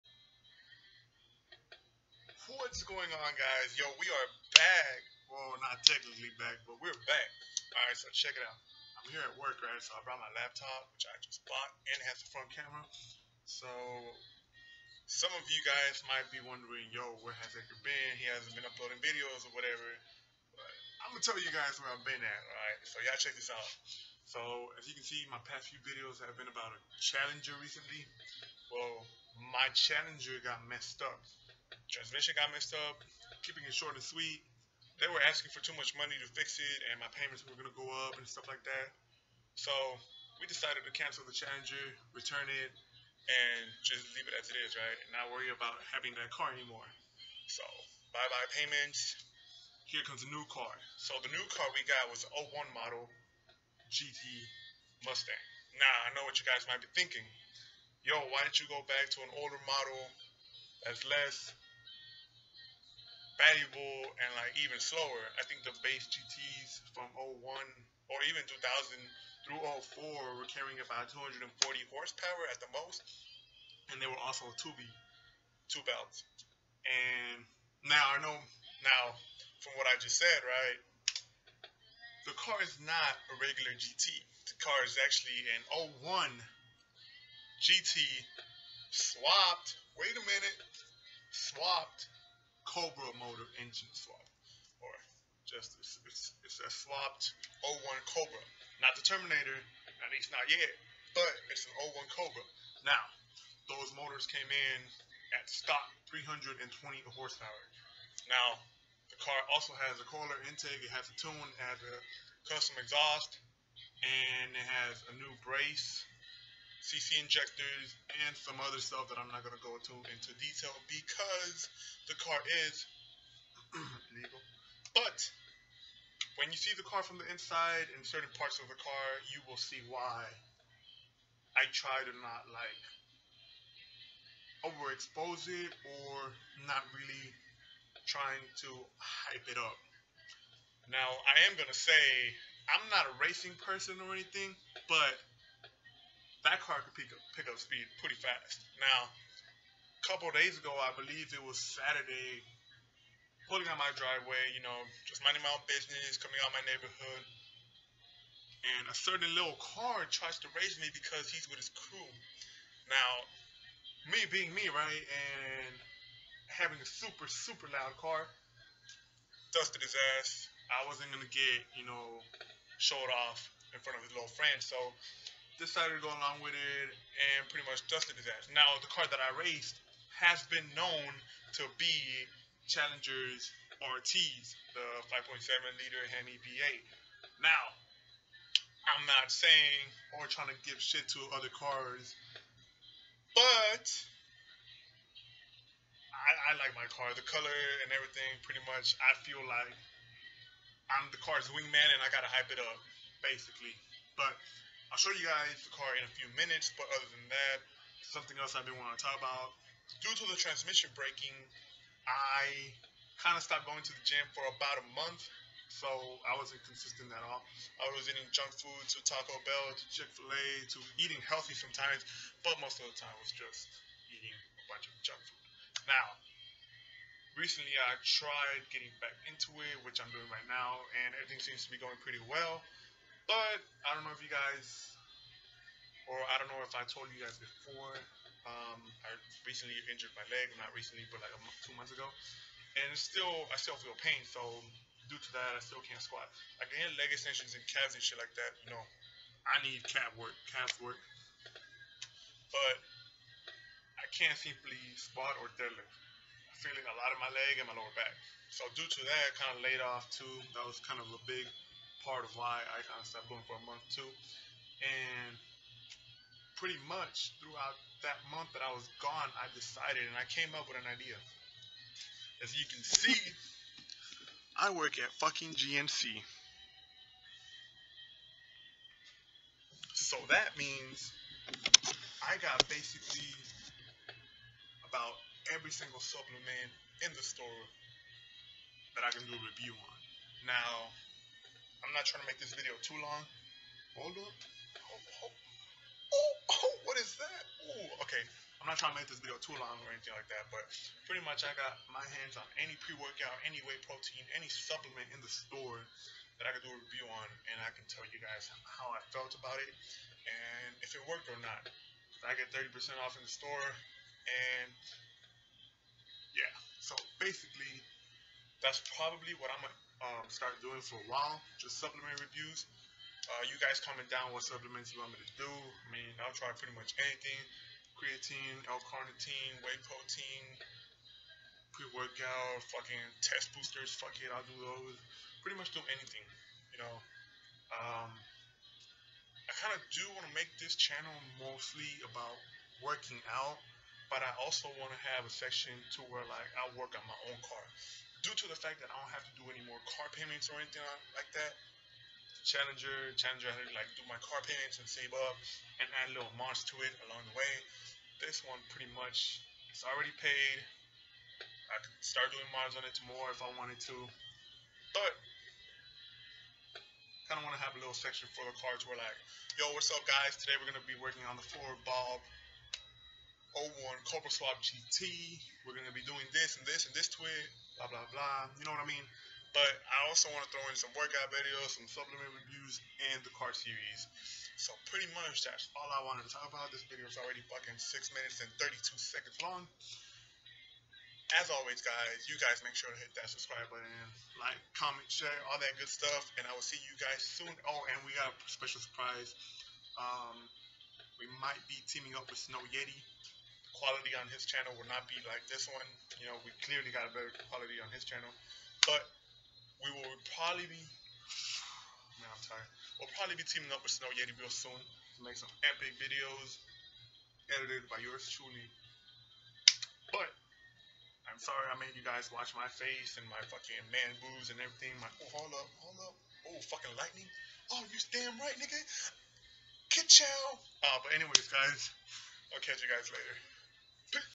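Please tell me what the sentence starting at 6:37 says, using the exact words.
Oh, and we got a special surprise.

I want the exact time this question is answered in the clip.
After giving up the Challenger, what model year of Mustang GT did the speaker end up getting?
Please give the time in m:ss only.
0:52.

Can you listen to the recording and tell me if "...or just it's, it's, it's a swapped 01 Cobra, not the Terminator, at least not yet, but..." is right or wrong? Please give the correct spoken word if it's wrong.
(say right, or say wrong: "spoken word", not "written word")
right.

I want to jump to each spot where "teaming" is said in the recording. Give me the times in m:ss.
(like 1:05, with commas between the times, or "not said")
6:41, 6:53.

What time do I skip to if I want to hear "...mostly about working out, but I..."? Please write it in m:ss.
5:41.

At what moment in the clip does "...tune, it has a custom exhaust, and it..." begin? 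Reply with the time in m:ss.
1:51.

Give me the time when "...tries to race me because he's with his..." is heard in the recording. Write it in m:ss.
2:40.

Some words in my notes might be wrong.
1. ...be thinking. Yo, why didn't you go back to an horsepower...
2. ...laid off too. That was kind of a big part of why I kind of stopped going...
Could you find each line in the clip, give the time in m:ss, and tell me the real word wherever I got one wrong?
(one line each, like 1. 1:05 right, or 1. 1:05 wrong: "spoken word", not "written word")
1. 0:56 wrong: "older", not "horsepower"
2. 4:19 right.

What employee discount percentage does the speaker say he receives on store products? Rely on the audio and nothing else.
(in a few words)
30%.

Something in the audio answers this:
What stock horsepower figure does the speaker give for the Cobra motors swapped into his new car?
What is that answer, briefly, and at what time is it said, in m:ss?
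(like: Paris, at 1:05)
320, at 1:45.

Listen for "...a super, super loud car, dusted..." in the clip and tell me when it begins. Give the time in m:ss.
2:46.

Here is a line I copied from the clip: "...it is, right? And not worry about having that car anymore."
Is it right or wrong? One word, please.
right.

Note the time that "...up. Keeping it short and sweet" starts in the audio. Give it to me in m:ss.
0:32.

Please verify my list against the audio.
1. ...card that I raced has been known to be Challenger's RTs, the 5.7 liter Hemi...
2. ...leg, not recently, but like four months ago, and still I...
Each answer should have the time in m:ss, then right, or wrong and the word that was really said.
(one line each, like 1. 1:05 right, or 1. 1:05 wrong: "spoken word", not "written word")
1. 2:58 right
2. 4:00 wrong: "two", not "four".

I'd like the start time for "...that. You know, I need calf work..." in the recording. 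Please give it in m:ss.
4:08.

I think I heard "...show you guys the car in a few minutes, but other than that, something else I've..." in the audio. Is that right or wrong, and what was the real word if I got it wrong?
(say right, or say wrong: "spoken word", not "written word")
right.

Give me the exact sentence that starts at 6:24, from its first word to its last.
So pretty much that's all I wanted to talk about.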